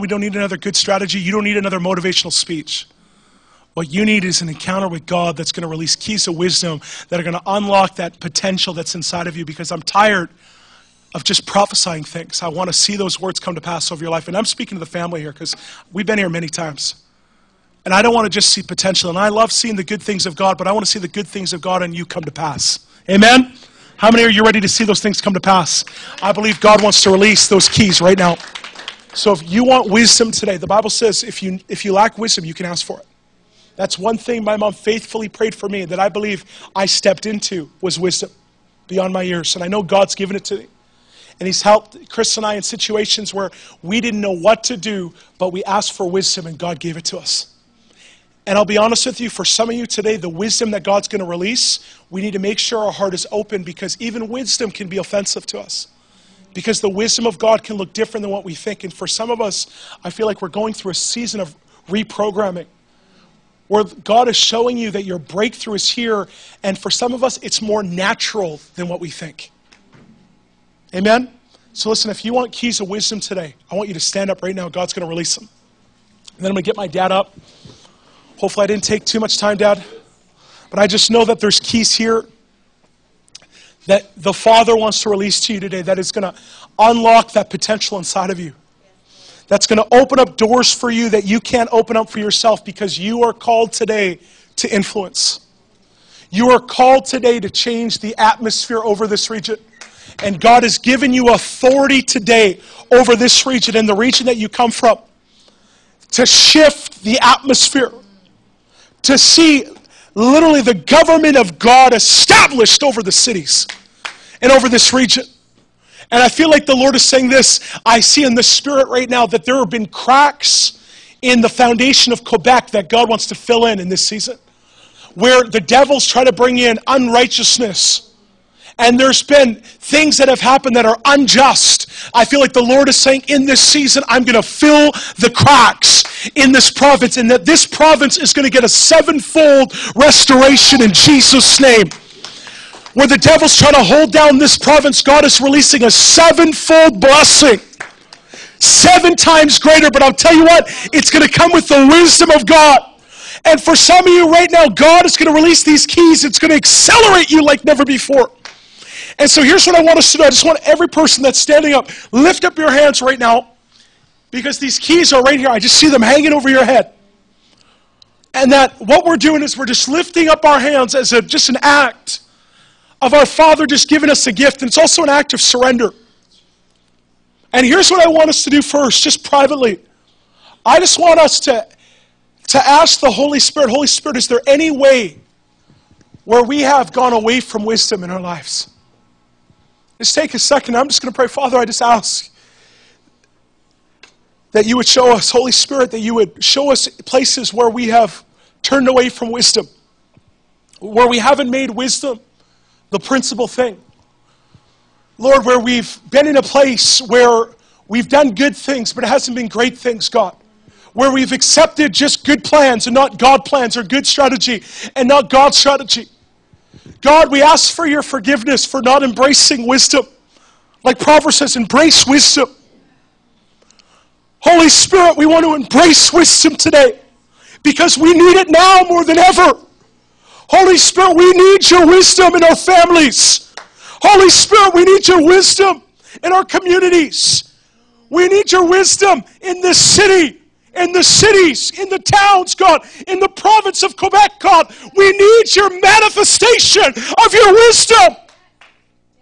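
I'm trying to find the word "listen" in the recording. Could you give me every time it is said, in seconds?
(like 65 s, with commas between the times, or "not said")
71 s.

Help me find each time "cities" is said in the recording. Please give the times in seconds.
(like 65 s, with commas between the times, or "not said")
113 s, 241 s.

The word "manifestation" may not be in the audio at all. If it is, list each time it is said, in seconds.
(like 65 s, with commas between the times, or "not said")
245 s.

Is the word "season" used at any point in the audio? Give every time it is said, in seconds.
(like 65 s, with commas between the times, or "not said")
60 s, 124 s, 133 s.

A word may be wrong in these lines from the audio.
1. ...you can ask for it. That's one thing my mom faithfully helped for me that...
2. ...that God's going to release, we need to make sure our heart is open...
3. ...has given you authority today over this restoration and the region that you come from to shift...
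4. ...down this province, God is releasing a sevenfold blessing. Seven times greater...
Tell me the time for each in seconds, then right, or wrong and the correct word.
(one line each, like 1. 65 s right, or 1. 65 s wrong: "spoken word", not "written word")
1. 32 s wrong: "prayed", not "helped"
2. 50 s right
3. 100 s wrong: "region", not "restoration"
4. 144 s right.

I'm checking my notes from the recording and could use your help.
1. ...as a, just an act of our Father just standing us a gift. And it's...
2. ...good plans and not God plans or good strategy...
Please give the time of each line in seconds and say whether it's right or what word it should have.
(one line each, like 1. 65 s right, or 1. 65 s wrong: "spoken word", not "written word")
1. 170 s wrong: "giving", not "standing"
2. 212 s right.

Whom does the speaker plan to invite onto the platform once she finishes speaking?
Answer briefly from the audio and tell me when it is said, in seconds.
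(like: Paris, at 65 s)
My dad, at 76 s.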